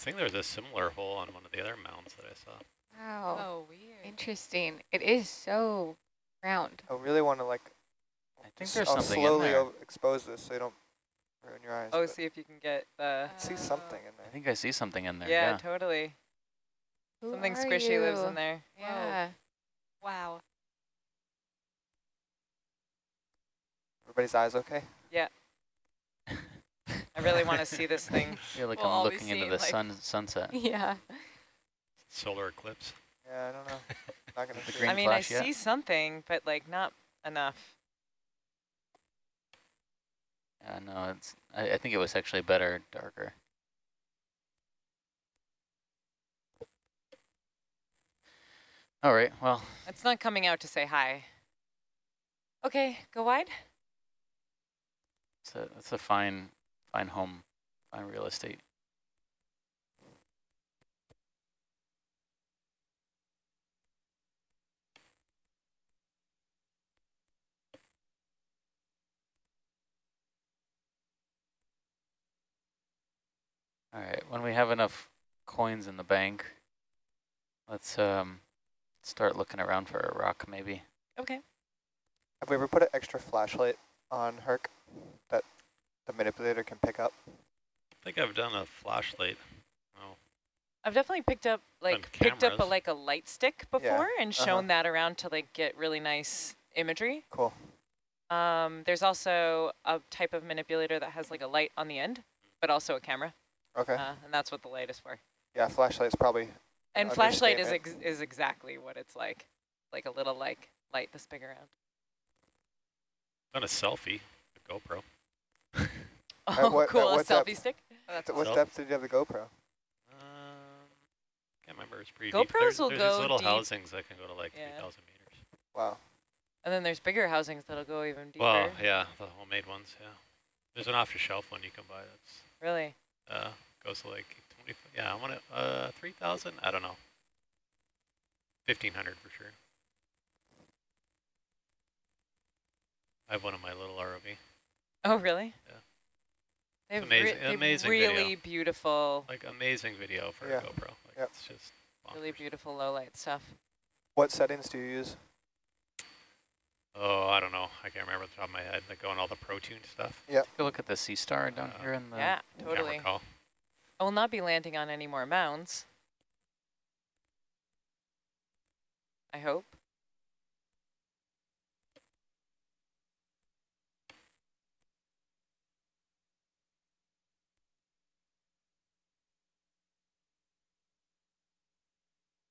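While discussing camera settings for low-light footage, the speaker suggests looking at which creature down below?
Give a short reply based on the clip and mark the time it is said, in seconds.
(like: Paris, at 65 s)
Sea star, at 160 s.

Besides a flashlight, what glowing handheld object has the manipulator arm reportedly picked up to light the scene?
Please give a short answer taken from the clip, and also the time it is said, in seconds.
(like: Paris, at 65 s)
Light stick, at 92 s.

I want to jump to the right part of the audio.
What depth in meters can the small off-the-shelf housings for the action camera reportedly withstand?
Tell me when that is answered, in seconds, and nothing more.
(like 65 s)
124 s.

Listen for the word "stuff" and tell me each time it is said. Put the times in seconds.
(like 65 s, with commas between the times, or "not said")
153 s, 159 s.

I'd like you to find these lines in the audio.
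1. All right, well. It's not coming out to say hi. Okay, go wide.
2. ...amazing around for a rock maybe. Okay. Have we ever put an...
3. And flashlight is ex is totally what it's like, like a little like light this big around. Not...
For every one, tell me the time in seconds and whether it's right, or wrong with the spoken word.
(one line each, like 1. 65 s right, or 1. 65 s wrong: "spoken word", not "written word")
1. 49 s right
2. 79 s wrong: "looking", not "amazing"
3. 106 s wrong: "exactly", not "totally".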